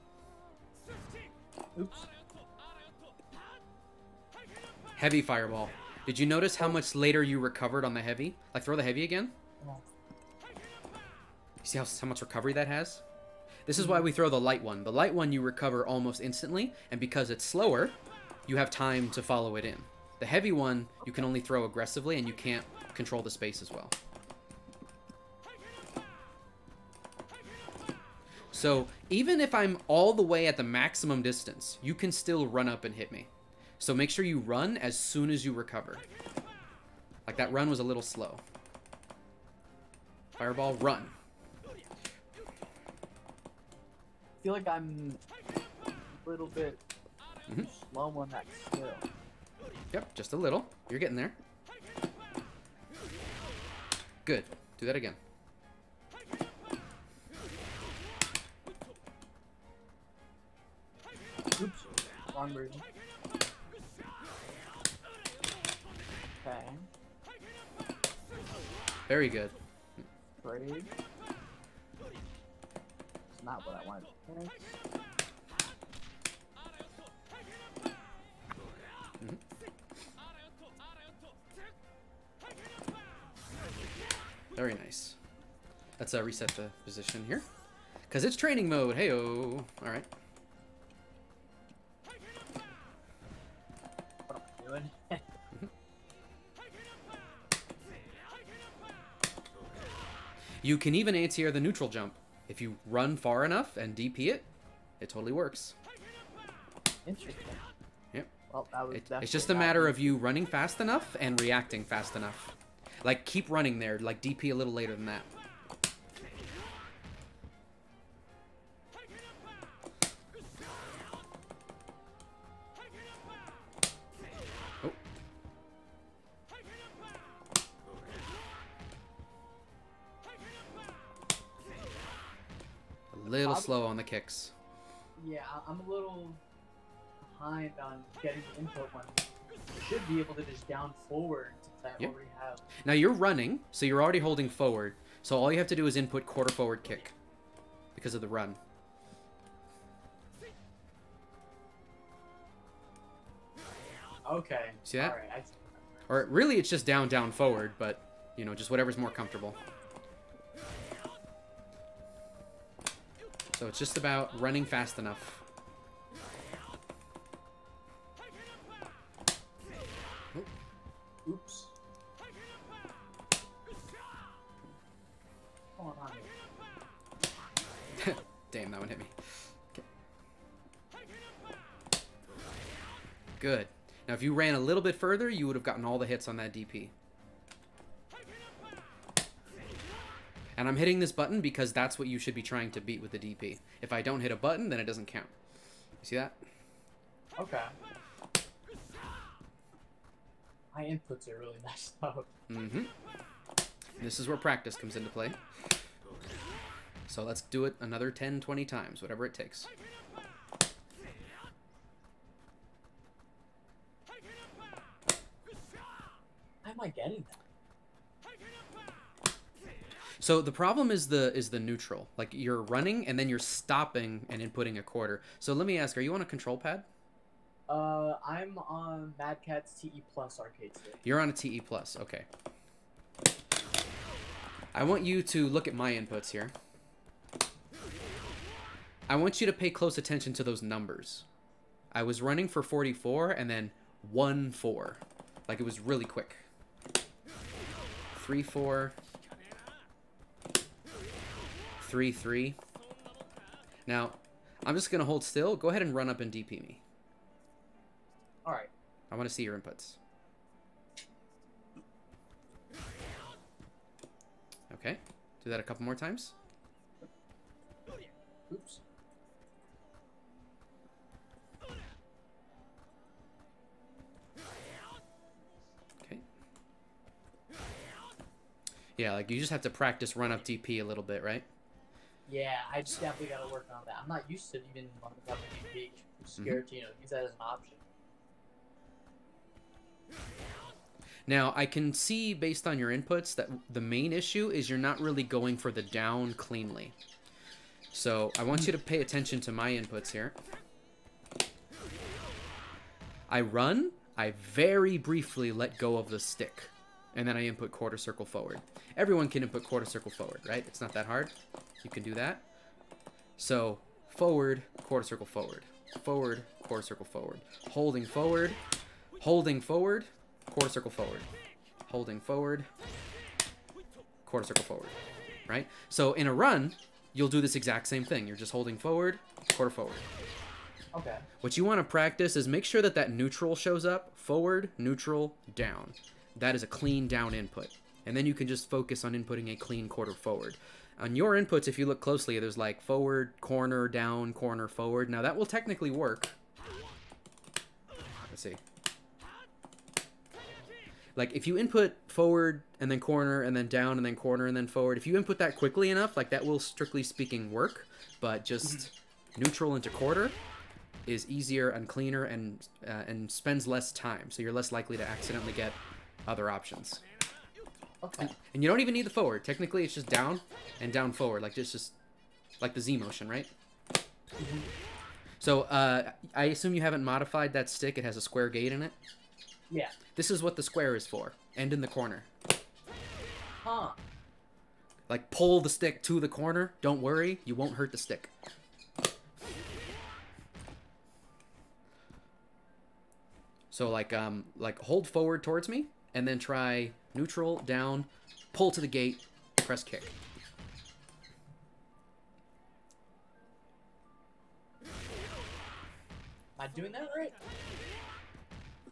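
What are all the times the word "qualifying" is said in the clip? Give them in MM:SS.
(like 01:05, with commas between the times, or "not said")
not said.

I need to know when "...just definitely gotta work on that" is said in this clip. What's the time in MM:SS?
04:42.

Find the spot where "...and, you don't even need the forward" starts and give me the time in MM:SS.
06:08.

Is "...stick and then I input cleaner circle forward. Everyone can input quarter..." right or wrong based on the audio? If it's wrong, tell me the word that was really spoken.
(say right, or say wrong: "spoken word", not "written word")
wrong: "quarter", not "cleaner".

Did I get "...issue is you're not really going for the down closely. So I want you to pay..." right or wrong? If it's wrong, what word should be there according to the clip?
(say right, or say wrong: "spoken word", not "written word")
wrong: "cleanly", not "closely".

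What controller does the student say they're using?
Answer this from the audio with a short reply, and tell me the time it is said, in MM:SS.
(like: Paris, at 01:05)
Mad Catz TE Plus, at 03:49.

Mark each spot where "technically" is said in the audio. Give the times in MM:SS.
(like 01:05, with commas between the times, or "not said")
05:45, 06:09.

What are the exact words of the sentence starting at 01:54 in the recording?
Like, DP a little later than that.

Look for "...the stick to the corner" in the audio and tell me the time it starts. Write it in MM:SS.
06:25.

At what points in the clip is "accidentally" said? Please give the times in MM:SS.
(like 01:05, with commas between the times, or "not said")
06:05.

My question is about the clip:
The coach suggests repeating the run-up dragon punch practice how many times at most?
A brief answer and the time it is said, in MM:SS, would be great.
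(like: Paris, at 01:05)
20, at 03:28.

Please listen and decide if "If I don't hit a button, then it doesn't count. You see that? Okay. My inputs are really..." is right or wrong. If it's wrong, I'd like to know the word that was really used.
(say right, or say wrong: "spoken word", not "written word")
right.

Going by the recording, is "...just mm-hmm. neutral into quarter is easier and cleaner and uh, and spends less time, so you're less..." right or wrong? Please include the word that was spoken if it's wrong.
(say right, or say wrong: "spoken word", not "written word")
right.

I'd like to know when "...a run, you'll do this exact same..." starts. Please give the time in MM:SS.
05:26.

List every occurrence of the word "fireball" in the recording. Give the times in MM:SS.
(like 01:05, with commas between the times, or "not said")
00:05, 00:40.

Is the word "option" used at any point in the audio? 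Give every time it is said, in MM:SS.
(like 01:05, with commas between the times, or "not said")
04:47, 06:06.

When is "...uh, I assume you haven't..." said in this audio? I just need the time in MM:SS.
06:15.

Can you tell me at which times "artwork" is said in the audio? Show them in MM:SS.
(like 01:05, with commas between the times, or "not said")
not said.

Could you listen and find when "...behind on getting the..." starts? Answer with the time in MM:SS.
02:17.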